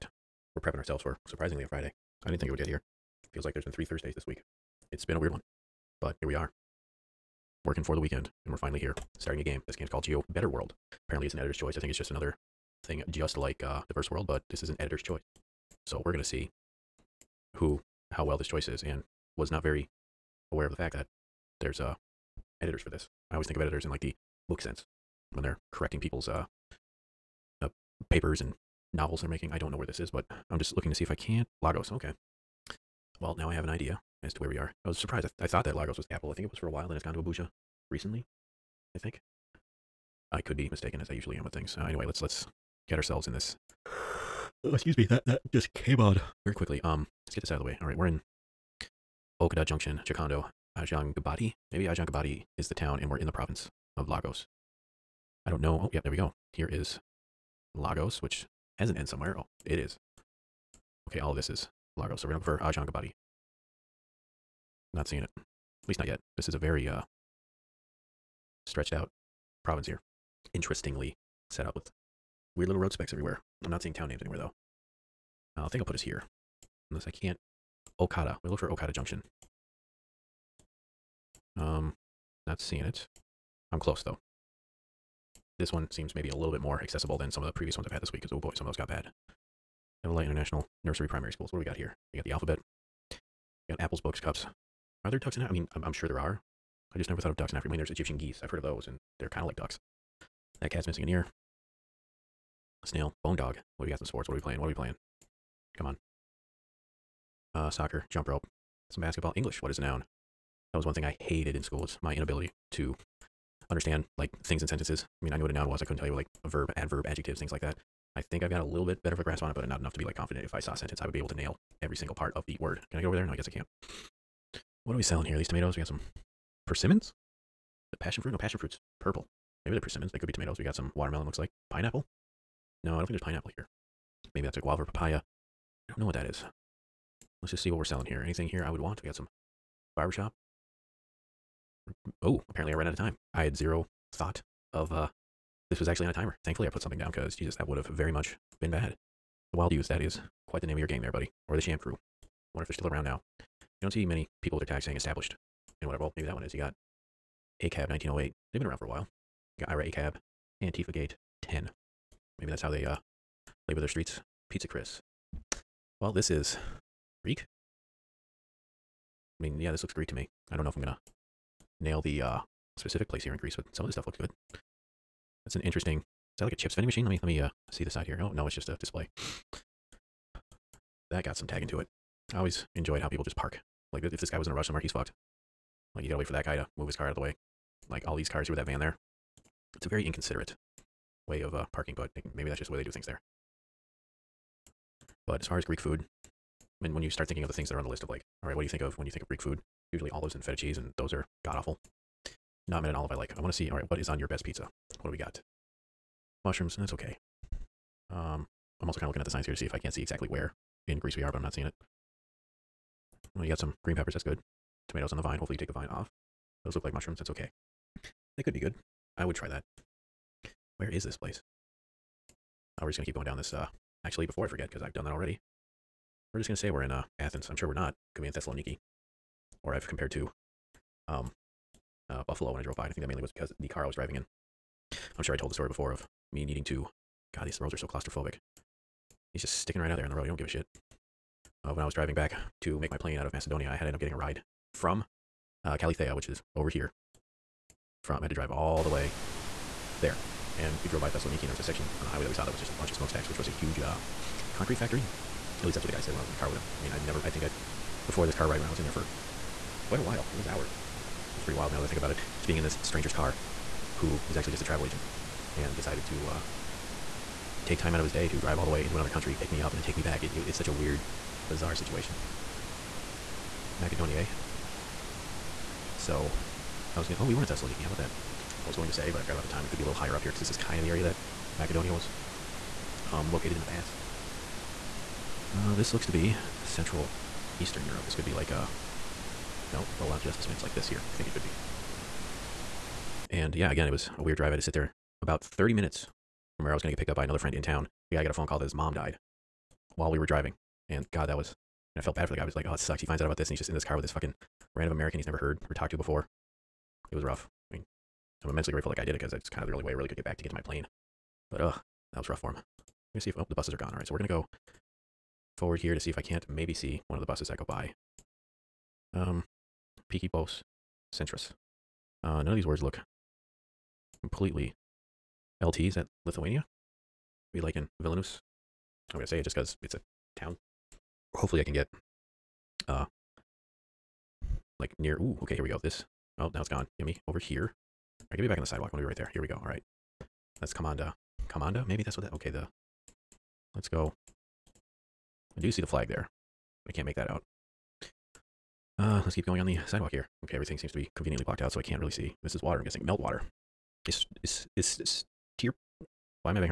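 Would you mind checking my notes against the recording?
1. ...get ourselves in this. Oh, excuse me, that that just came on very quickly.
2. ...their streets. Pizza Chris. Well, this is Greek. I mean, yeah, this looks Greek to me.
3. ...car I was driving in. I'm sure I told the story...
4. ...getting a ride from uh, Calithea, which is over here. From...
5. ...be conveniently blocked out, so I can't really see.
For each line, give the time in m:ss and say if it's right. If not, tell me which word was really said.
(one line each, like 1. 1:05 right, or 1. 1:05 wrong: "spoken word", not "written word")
1. 0:42 right
2. 2:43 right
3. 3:53 right
4. 4:03 right
5. 5:50 right.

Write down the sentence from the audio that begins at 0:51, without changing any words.
Maybe Ajangabadi is the town and we're in the province of Lagos.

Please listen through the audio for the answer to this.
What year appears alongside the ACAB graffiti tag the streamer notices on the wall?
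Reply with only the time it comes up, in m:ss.
2:37.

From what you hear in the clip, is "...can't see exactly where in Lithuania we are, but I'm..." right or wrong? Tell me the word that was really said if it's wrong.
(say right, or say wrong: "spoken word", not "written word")
wrong: "Greece", not "Lithuania".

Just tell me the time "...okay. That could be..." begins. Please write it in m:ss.
3:37.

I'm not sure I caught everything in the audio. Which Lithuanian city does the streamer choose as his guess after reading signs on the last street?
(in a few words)
Vilnius.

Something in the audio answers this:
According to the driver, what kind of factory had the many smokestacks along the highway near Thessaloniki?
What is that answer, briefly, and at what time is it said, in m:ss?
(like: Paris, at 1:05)
concrete factory, at 4:14.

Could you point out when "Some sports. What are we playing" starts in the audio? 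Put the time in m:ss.
1:43.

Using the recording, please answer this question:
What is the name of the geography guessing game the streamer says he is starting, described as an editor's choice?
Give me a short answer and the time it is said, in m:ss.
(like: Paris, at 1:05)
Geo Better World, at 0:10.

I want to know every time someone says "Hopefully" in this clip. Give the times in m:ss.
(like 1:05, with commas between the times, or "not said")
3:35, 5:31.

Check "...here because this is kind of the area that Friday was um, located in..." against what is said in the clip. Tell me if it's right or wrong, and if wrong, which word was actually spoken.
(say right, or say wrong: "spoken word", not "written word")
wrong: "Macedonia", not "Friday".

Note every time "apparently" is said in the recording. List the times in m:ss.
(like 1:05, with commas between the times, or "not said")
0:11, 2:22.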